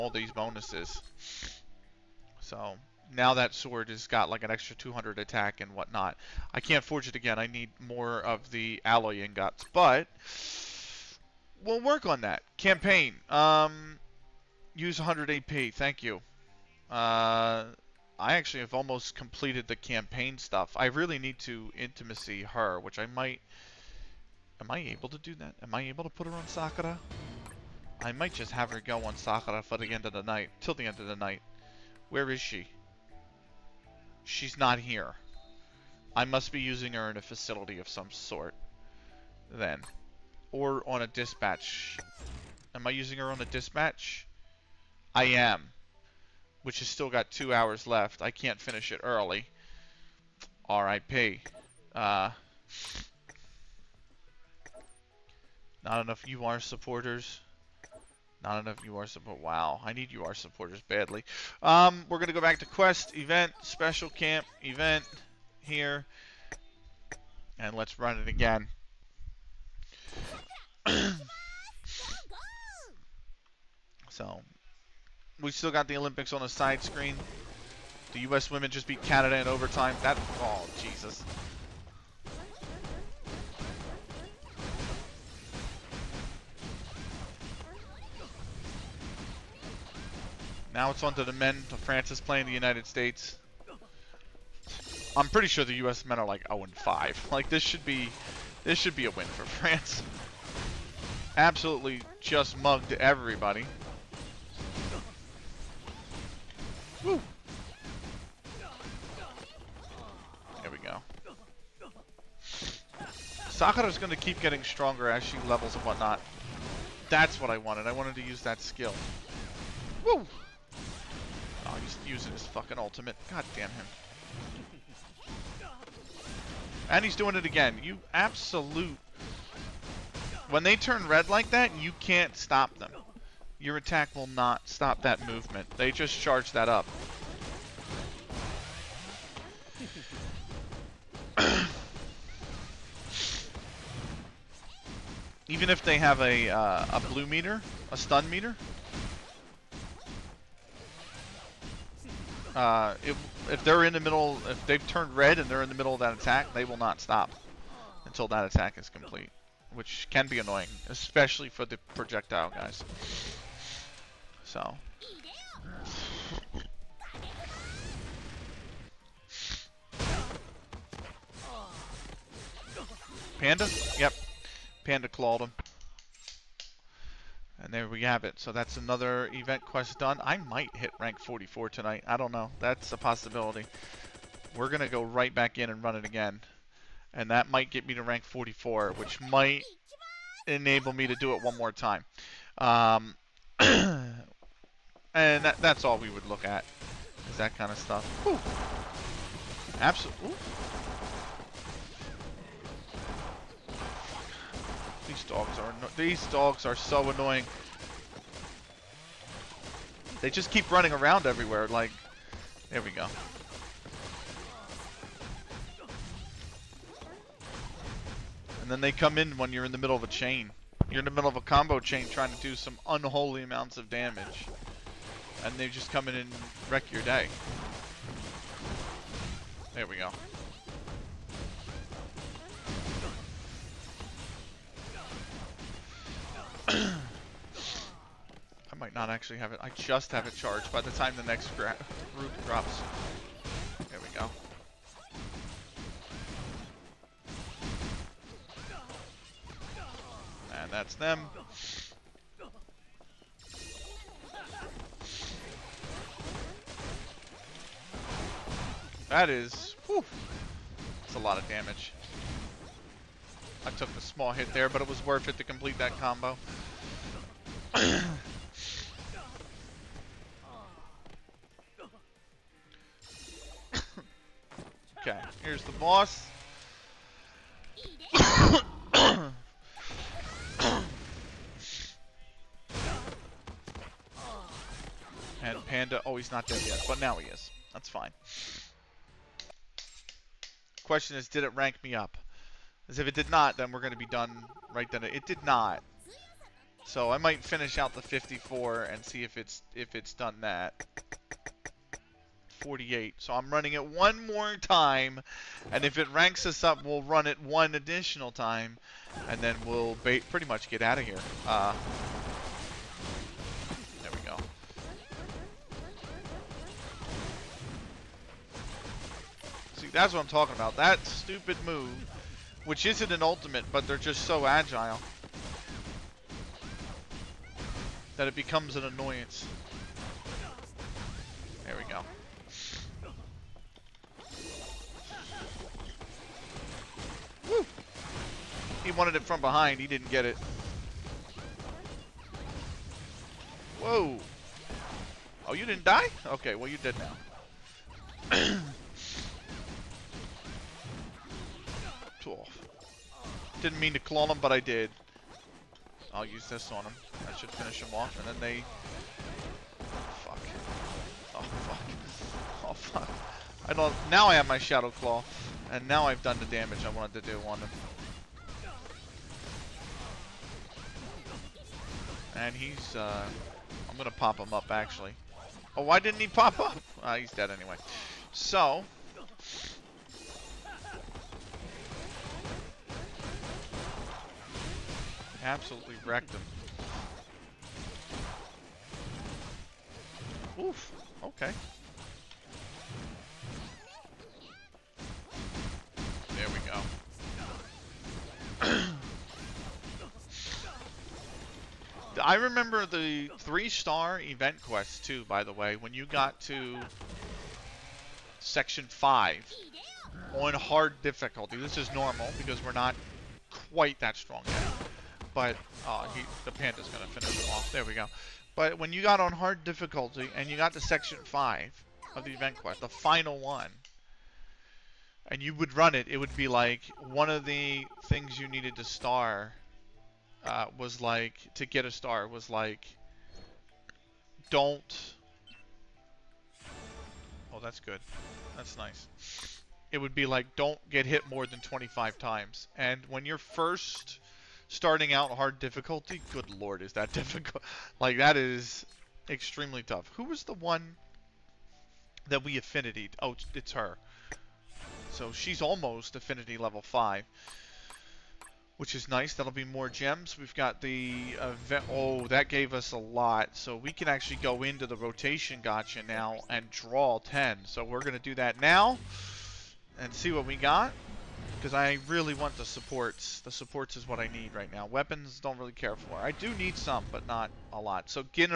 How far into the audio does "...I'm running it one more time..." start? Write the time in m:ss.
5:03.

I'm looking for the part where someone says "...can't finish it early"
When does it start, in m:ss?
0:48.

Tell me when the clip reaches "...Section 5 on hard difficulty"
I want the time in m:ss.
6:48.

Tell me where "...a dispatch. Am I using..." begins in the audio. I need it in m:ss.
0:40.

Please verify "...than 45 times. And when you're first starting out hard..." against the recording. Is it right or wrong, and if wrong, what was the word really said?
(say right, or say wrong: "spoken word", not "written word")
wrong: "25", not "45".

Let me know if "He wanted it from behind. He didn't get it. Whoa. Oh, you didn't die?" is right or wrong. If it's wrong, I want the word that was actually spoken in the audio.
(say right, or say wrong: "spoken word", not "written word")
right.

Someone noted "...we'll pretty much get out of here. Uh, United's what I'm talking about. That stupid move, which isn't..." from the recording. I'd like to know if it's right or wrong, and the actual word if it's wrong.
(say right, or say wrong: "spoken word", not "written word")
wrong: "That", not "United".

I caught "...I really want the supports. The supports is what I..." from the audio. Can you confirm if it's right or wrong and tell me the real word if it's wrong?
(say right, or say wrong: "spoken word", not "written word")
right.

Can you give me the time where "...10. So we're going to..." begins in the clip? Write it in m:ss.
7:47.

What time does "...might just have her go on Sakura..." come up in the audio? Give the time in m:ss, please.
0:28.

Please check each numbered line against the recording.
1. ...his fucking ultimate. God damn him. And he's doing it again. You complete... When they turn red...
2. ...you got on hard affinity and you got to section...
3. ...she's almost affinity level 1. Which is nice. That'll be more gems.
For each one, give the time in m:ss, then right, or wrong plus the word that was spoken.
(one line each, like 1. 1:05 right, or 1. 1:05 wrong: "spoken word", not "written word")
1. 2:02 wrong: "absolute", not "complete"
2. 6:58 wrong: "difficulty", not "affinity"
3. 7:35 wrong: "5", not "1".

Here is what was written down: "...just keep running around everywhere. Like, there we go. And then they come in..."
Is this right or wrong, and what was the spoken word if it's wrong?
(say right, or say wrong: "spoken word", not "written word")
right.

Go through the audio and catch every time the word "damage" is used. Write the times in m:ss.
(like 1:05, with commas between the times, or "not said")
3:43, 4:21, 6:06.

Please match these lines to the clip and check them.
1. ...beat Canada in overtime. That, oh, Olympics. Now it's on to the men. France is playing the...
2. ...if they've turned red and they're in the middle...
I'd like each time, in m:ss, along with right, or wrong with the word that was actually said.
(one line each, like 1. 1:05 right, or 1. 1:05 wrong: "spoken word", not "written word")
1. 1:18 wrong: "Jesus", not "Olympics"
2. 2:34 right.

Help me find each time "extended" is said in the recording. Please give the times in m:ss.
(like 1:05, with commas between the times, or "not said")
not said.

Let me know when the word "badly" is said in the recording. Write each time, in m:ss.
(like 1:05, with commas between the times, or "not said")
1:00.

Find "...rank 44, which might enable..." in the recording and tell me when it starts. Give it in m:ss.
3:08.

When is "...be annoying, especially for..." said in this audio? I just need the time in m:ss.
2:40.